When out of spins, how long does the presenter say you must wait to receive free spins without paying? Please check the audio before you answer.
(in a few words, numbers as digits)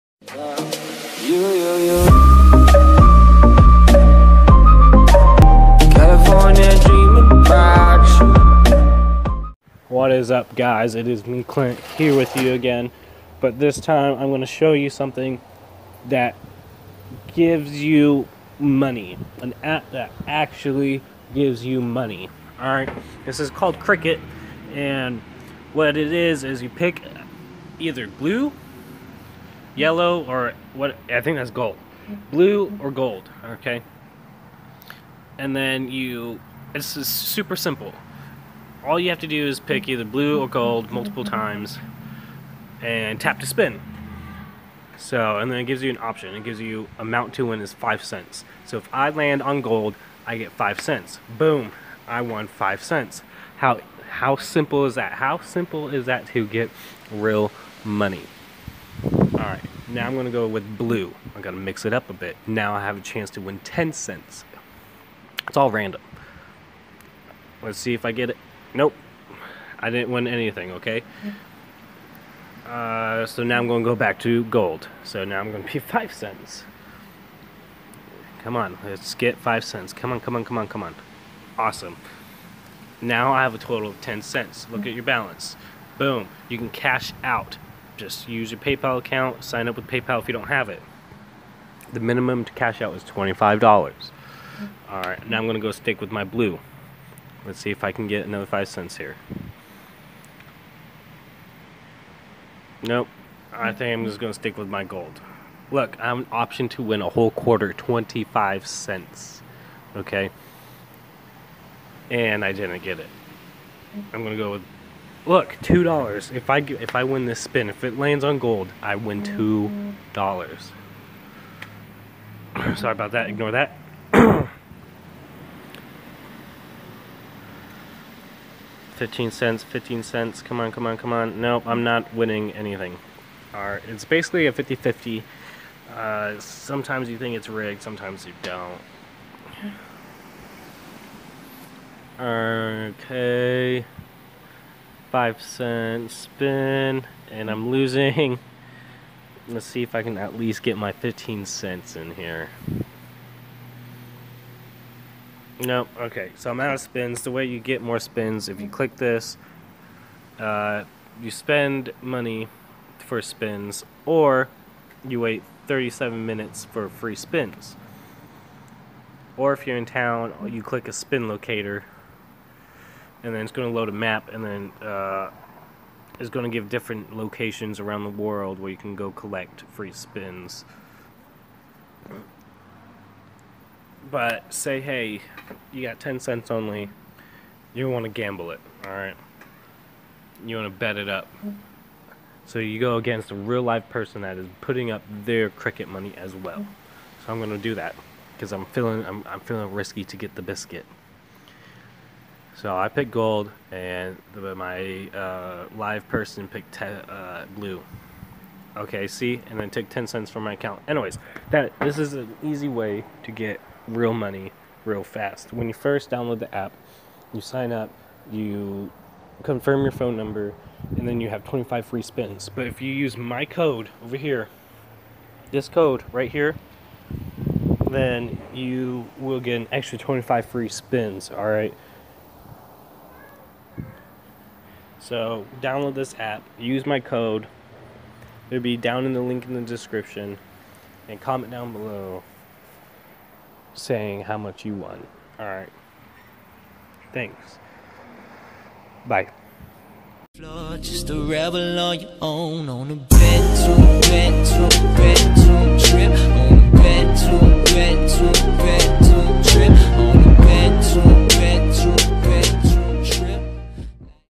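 37 minutes.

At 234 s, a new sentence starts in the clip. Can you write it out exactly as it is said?
So, download this app, use my code.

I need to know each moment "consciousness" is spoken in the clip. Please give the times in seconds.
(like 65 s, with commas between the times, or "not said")
not said.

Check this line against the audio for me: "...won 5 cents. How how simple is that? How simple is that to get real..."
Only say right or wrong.
right.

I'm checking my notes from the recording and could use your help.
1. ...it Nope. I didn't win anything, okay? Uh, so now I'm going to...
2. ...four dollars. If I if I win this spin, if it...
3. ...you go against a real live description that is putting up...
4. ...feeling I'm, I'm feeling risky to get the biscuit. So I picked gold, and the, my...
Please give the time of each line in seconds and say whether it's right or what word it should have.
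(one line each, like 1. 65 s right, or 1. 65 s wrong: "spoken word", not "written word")
1. 68 s right
2. 115 s wrong: "two", not "four"
3. 192 s wrong: "person", not "description"
4. 198 s right.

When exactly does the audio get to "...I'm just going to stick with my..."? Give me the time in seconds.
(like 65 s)
103 s.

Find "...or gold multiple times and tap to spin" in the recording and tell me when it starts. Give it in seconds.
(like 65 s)
40 s.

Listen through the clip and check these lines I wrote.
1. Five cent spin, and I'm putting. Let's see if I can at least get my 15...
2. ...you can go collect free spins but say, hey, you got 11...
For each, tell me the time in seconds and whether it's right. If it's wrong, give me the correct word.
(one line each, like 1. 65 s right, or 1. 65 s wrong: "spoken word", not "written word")
1. 145 s wrong: "losing", not "putting"
2. 178 s wrong: "10", not "11".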